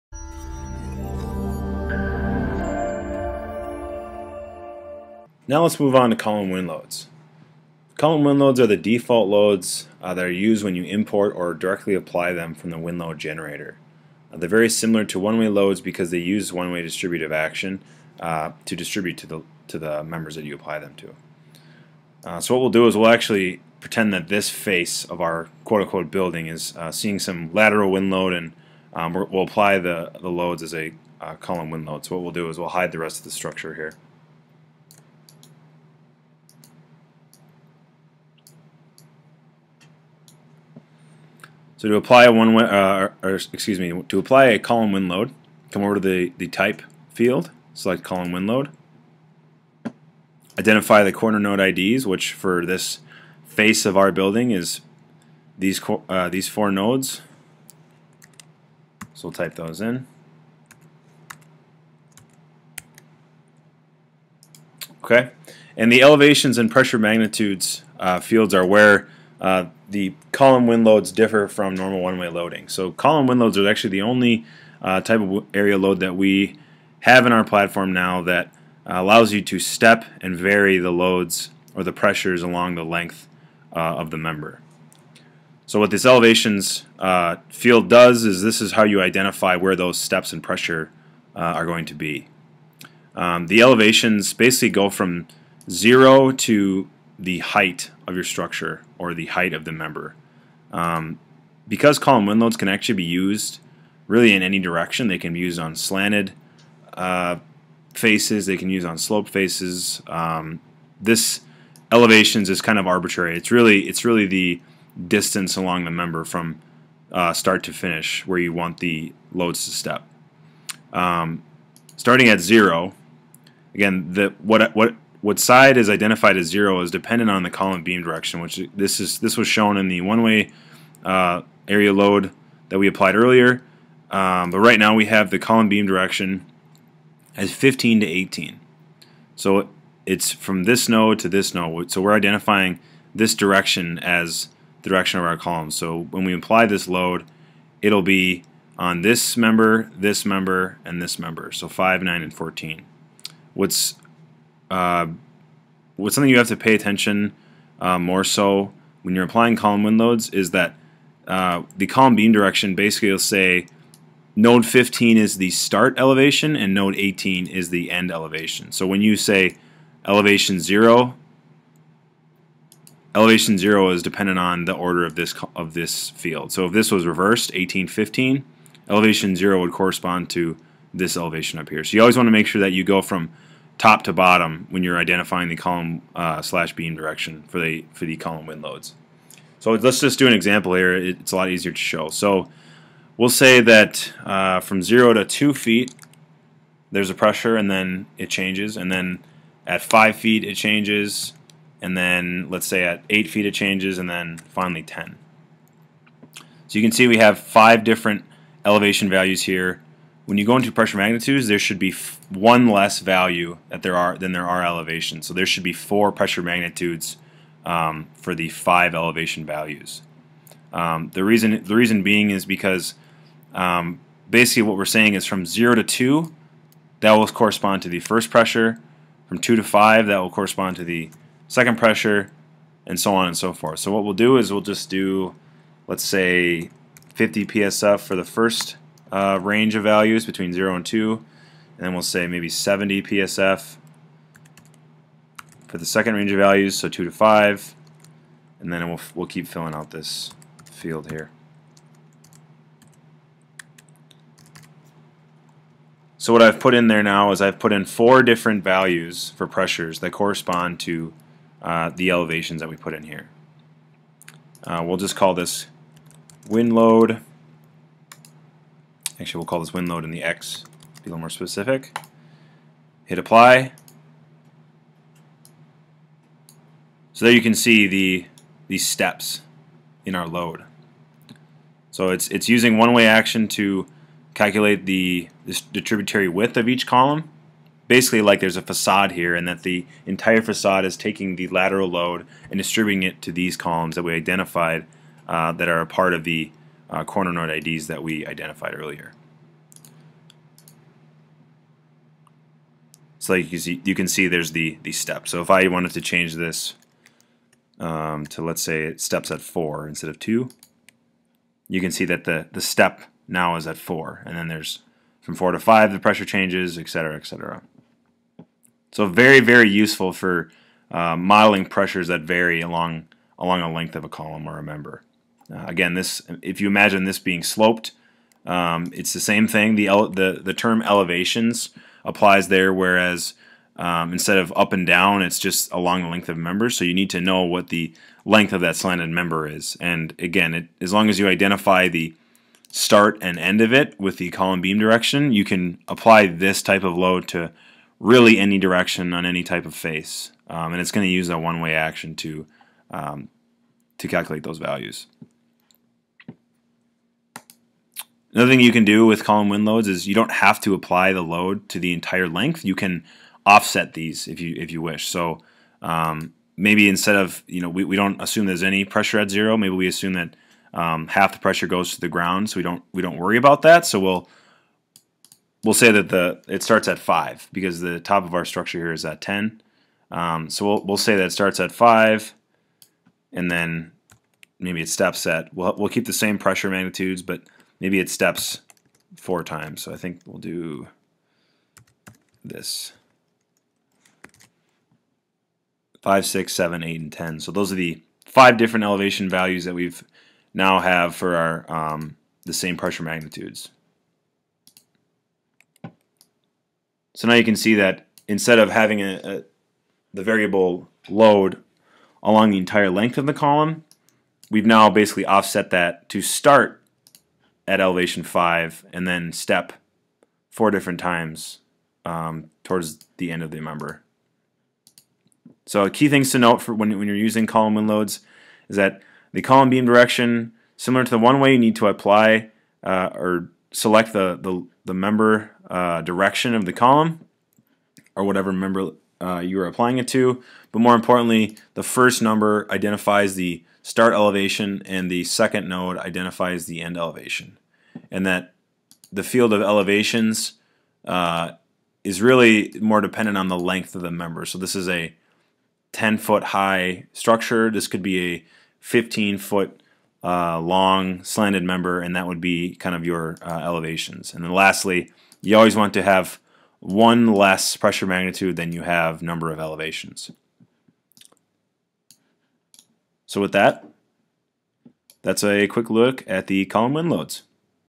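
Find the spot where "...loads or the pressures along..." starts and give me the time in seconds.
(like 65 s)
80 s.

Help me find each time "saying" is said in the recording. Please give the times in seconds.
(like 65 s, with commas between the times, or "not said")
224 s.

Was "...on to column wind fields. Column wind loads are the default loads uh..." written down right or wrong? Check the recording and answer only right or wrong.
wrong.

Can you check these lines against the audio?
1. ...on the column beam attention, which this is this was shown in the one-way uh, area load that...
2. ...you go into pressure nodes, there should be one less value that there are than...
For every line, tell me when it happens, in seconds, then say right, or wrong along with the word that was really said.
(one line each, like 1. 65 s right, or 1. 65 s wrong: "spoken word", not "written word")
1. 127 s wrong: "direction", not "attention"
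2. 210 s wrong: "magnitudes", not "nodes".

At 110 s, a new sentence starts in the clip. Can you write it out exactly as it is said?
Um, this elevations is kind of arbitrary.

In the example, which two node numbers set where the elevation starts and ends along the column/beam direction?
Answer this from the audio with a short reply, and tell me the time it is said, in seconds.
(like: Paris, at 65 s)
15 to 18, at 137 s.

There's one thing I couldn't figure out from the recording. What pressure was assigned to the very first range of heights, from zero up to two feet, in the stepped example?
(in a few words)
50 psf.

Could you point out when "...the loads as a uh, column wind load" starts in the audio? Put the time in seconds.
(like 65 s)
30 s.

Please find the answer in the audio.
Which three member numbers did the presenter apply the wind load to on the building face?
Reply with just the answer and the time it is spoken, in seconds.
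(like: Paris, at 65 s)
5, 9, and 14, at 151 s.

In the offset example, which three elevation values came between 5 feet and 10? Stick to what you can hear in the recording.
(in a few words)
6, 7, and 8.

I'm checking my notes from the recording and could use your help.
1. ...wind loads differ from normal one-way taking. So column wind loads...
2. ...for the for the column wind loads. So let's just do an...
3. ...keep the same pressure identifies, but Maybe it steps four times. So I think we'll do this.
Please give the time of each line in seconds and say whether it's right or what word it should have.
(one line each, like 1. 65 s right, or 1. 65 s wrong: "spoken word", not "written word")
1. 70 s wrong: "loading", not "taking"
2. 187 s right
3. 385 s wrong: "magnitudes", not "identifies".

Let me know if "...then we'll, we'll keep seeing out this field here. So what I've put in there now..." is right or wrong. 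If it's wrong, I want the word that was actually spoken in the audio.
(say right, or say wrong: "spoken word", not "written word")
wrong: "filling", not "seeing".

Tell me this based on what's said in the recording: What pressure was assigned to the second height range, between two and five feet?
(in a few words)
70 psf.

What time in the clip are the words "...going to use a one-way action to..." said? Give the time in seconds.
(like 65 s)
350 s.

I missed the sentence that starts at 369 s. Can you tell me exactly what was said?
Maybe we assume that um, half the pressure goes to the ground, so we don't we don't worry about that.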